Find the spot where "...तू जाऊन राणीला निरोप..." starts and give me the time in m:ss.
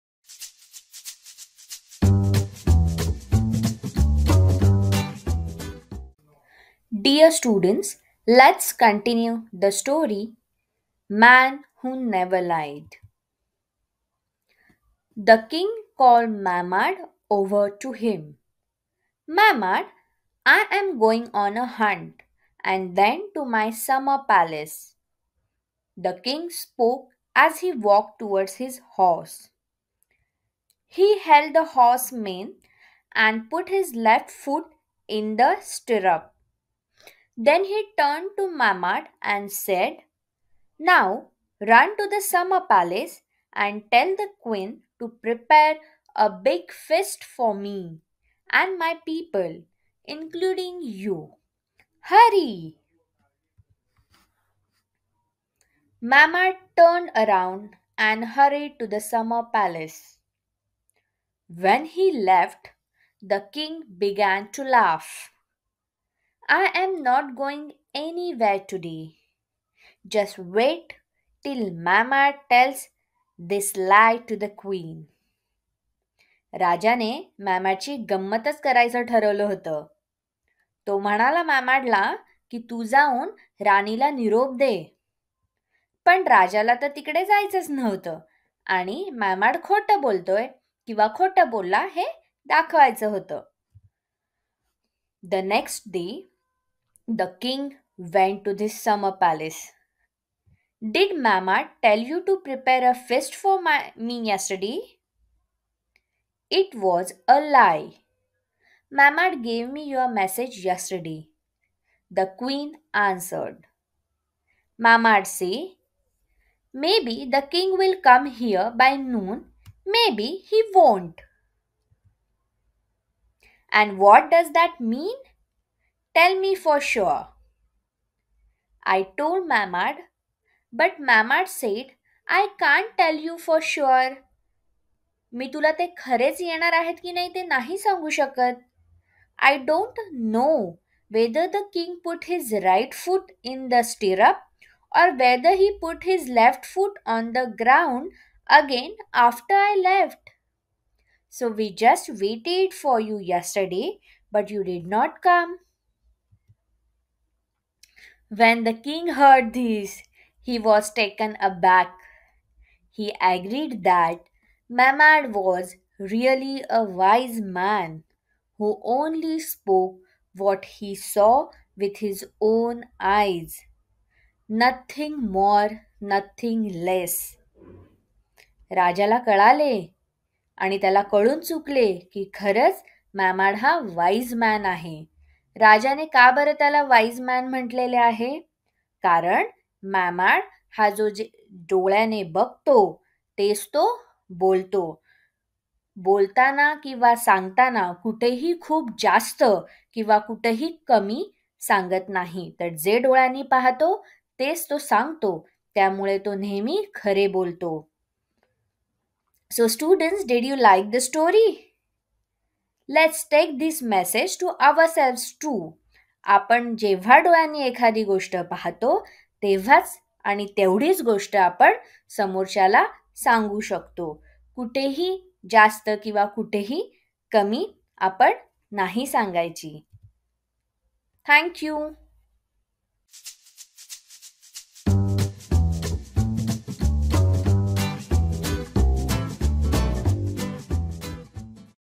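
1:22.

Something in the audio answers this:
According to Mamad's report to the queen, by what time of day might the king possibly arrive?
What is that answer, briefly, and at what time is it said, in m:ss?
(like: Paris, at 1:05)
Noon, at 1:58.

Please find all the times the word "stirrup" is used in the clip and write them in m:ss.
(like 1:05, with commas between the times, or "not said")
0:35.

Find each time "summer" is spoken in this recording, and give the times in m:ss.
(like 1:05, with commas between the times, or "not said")
0:23, 0:42, 0:58, 1:38.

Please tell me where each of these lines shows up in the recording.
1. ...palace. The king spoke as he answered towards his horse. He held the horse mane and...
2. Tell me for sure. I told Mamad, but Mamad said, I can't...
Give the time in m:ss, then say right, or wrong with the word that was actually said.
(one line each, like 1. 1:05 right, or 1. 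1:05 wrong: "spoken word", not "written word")
1. 0:24 wrong: "walked", not "answered"
2. 2:06 right.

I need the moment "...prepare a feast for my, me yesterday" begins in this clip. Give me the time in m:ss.
1:42.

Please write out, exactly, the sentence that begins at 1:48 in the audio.
Mamad gave me your message yesterday.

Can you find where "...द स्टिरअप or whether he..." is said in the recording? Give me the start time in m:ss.
2:23.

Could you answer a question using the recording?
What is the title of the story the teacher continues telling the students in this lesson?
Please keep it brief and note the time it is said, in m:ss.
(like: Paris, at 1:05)
Man Who Never Lied, at 0:11.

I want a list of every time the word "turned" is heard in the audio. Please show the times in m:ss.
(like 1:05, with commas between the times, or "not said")
0:37, 0:56.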